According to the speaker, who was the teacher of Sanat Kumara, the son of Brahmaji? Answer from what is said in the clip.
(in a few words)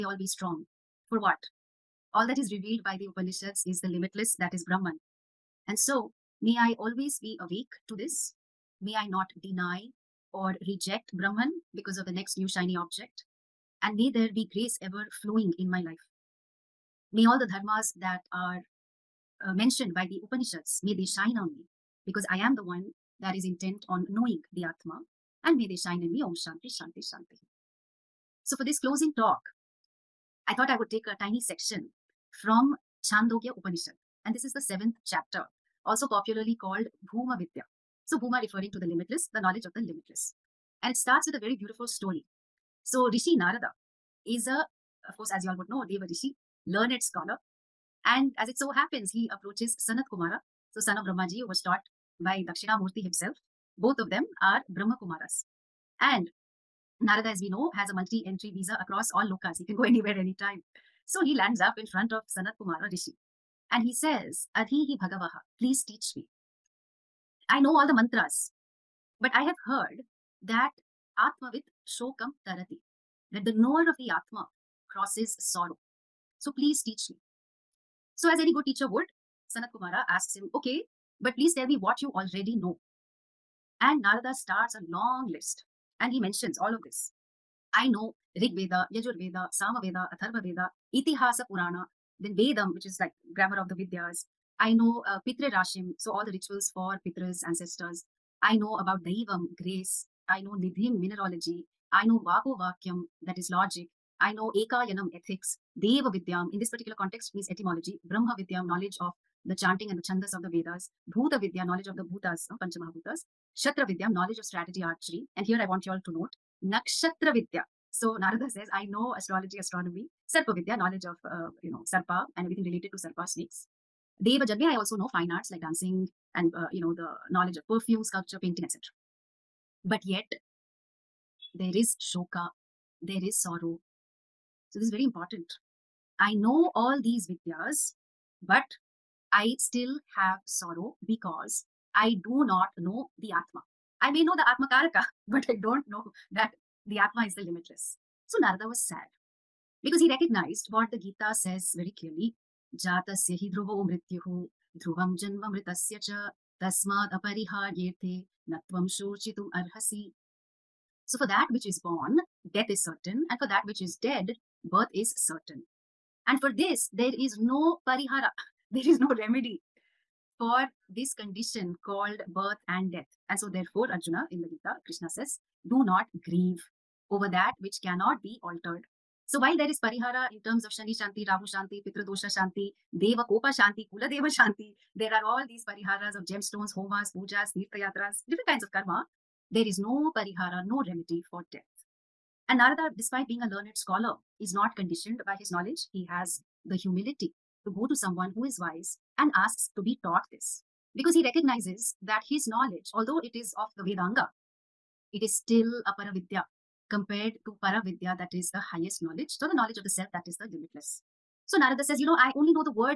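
Dakshinamurti.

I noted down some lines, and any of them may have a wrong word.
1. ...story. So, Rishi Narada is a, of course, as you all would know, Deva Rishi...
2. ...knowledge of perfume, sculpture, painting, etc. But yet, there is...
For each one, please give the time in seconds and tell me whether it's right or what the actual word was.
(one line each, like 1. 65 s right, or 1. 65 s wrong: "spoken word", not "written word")
1. 41 s right
2. 127 s right.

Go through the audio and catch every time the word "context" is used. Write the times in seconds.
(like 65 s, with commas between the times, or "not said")
106 s.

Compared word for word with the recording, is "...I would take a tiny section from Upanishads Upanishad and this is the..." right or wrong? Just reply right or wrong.
wrong.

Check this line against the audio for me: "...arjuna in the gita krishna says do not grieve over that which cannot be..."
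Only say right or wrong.
right.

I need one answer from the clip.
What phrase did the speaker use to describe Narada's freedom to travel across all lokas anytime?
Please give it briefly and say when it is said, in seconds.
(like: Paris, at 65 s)
multi entry visa, at 57 s.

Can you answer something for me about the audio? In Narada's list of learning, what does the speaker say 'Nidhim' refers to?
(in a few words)
Mineralogy.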